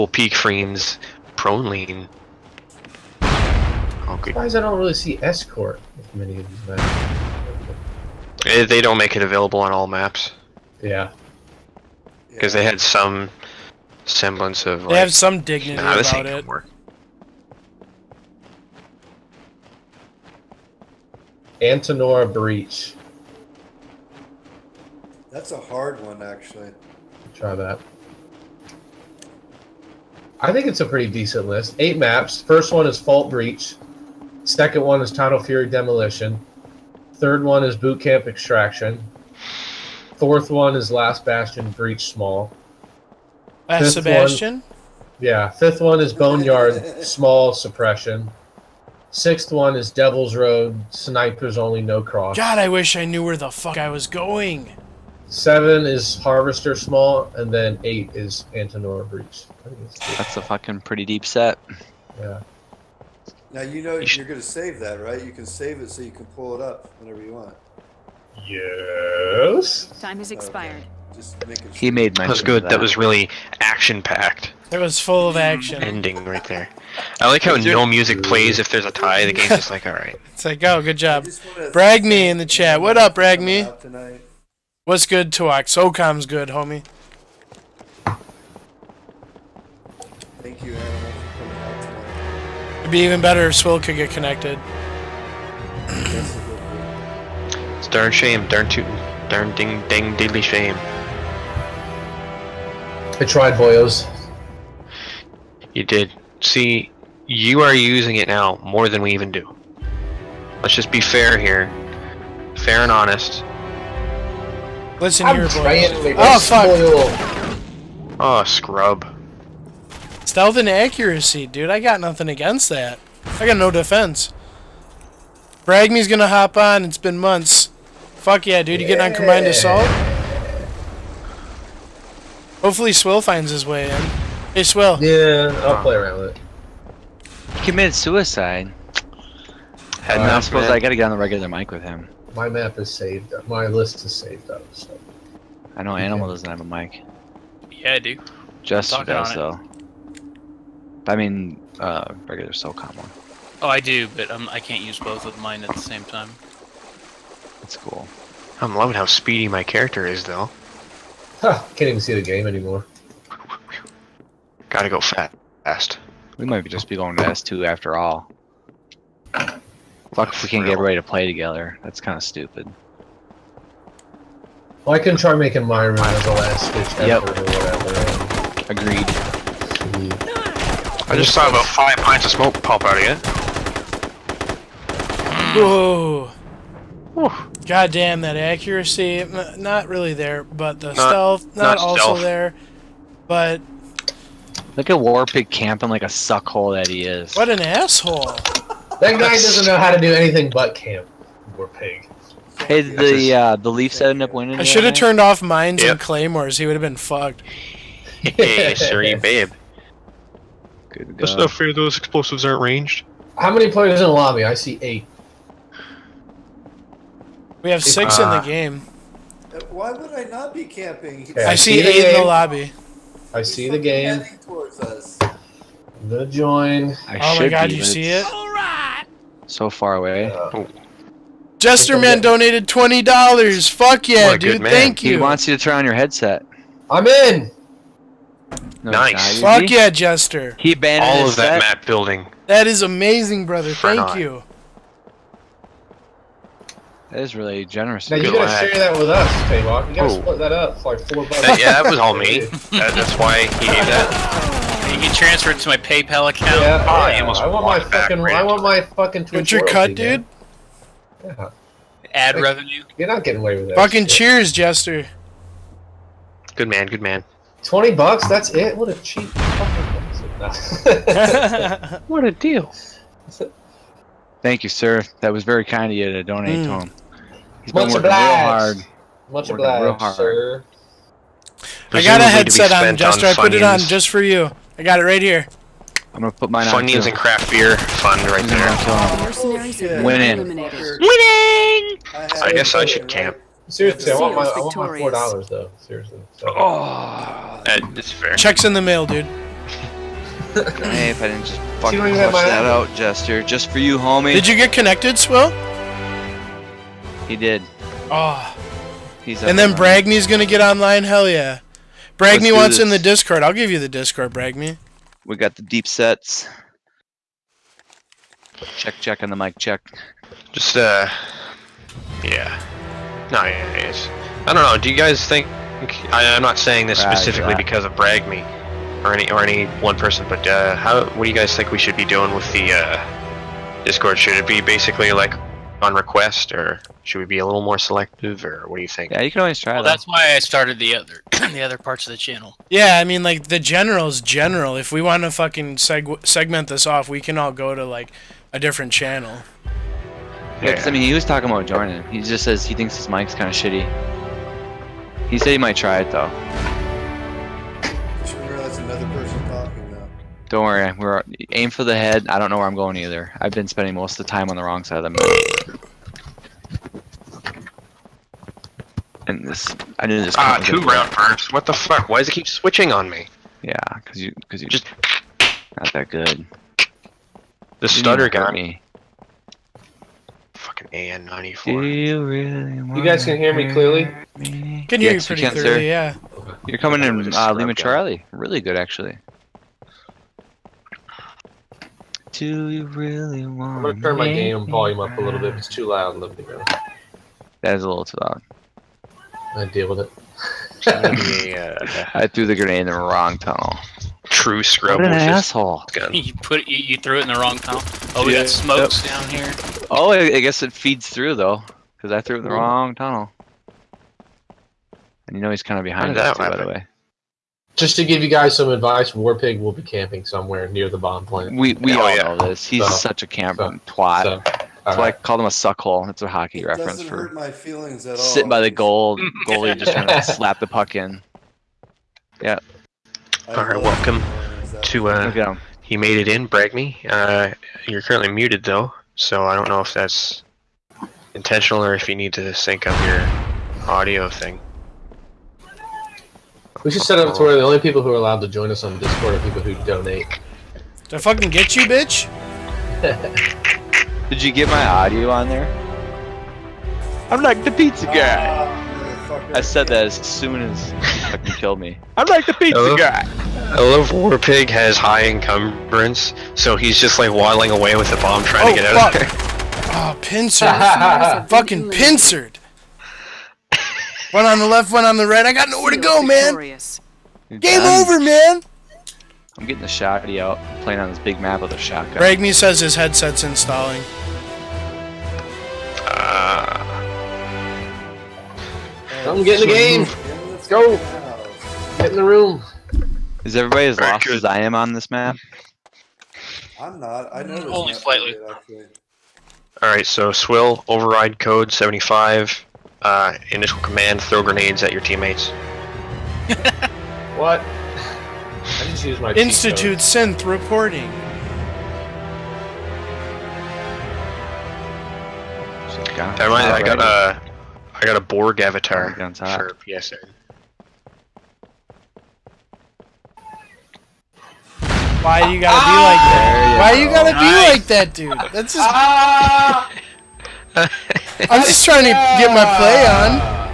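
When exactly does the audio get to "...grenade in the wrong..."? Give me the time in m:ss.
6:42.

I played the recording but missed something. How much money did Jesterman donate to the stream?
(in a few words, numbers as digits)
$20.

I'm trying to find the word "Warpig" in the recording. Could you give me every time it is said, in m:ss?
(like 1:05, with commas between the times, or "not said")
3:14, 3:21, 6:59.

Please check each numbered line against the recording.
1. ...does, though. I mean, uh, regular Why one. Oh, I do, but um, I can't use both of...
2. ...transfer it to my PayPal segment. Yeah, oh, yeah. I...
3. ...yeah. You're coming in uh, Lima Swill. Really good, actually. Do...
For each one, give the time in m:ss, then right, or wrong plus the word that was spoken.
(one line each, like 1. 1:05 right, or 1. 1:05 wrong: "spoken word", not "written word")
1. 2:29 wrong: "SOCOM", not "Why"
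2. 4:15 wrong: "account", not "segment"
3. 6:25 wrong: "Charlie", not "Swill".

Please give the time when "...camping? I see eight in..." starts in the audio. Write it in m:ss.
3:40.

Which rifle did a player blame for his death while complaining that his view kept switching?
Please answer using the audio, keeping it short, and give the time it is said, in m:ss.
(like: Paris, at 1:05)
AN94, at 6:20.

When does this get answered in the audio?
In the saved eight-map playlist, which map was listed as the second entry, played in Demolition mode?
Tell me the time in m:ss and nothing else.
0:35.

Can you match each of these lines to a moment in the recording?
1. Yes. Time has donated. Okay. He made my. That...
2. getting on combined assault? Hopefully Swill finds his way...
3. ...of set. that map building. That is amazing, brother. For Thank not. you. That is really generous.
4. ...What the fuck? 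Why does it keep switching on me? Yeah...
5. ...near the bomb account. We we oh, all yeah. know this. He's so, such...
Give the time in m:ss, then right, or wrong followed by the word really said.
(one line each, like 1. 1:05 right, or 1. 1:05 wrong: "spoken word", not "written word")
1. 1:08 wrong: "expired", not "donated"
2. 2:08 right
3. 4:01 right
4. 6:11 right
5. 7:00 wrong: "plant", not "account".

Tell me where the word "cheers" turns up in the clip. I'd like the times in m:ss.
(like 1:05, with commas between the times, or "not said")
4:24.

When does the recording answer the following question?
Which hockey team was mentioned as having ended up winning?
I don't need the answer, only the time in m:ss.
3:23.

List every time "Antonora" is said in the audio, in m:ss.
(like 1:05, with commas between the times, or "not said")
0:21, 0:58.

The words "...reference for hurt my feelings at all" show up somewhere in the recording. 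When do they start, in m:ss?
7:06.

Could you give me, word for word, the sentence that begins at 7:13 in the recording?
all right, welcome to uh, he made it in, Bragney.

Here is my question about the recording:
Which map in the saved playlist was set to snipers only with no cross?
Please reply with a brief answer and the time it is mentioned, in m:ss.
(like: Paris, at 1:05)
Devil's Road, at 0:49.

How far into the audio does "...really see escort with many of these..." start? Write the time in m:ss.
0:04.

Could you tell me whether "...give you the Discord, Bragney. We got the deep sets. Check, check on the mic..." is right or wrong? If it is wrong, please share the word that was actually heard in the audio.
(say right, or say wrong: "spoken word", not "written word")
right.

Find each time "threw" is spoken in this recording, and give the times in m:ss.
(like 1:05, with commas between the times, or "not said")
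6:42, 6:46, 6:52.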